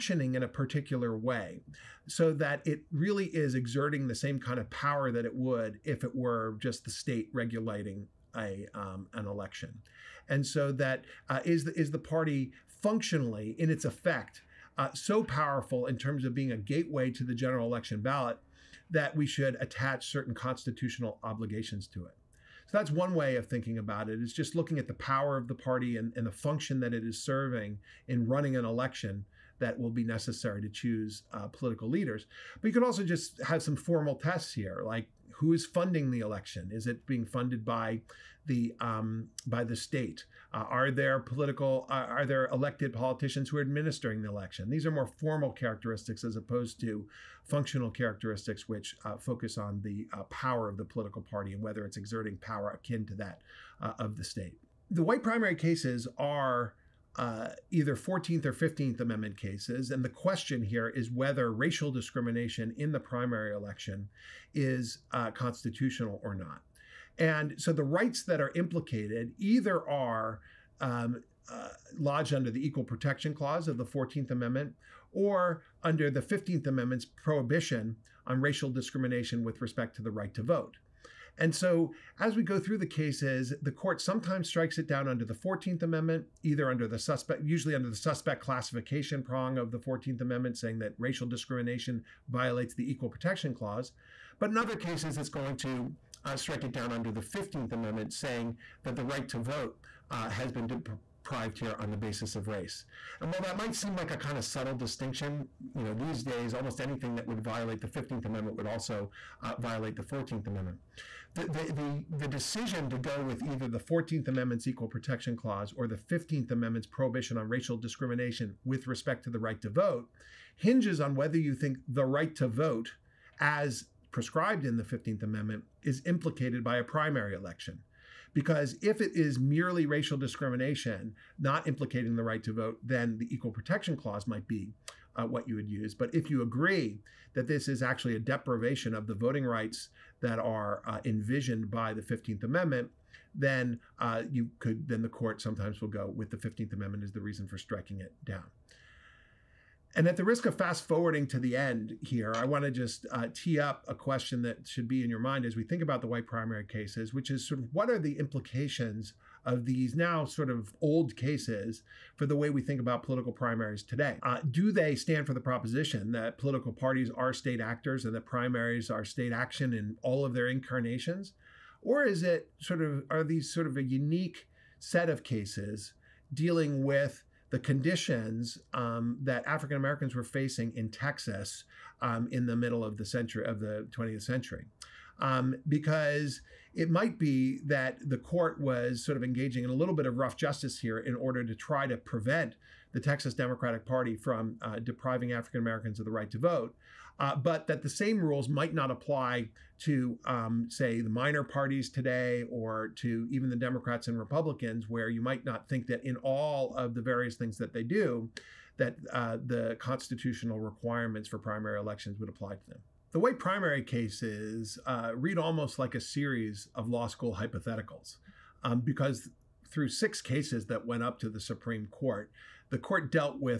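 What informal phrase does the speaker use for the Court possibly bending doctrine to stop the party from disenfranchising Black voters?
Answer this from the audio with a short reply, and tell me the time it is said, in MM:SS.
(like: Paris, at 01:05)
rough justice, at 03:10.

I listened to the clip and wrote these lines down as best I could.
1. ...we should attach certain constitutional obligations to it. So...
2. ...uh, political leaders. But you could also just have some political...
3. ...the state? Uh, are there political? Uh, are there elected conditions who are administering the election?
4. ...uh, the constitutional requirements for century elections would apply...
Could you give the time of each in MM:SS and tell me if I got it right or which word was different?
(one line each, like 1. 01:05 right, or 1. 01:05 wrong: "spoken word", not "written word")
1. 00:19 right
2. 00:31 wrong: "formal", not "political"
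3. 00:39 wrong: "politicians", not "conditions"
4. 03:29 wrong: "primary", not "century".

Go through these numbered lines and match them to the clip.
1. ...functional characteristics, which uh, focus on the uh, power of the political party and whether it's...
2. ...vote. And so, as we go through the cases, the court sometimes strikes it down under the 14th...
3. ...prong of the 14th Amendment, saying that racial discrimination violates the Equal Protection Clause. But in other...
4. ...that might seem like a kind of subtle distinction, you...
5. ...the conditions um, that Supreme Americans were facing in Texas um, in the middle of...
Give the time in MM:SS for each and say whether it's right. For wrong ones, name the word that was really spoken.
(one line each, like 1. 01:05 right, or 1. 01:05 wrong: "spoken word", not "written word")
1. 00:47 right
2. 01:20 right
3. 01:29 right
4. 01:43 right
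5. 02:57 wrong: "African", not "Supreme".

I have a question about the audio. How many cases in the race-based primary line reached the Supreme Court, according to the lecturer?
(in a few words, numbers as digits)
6.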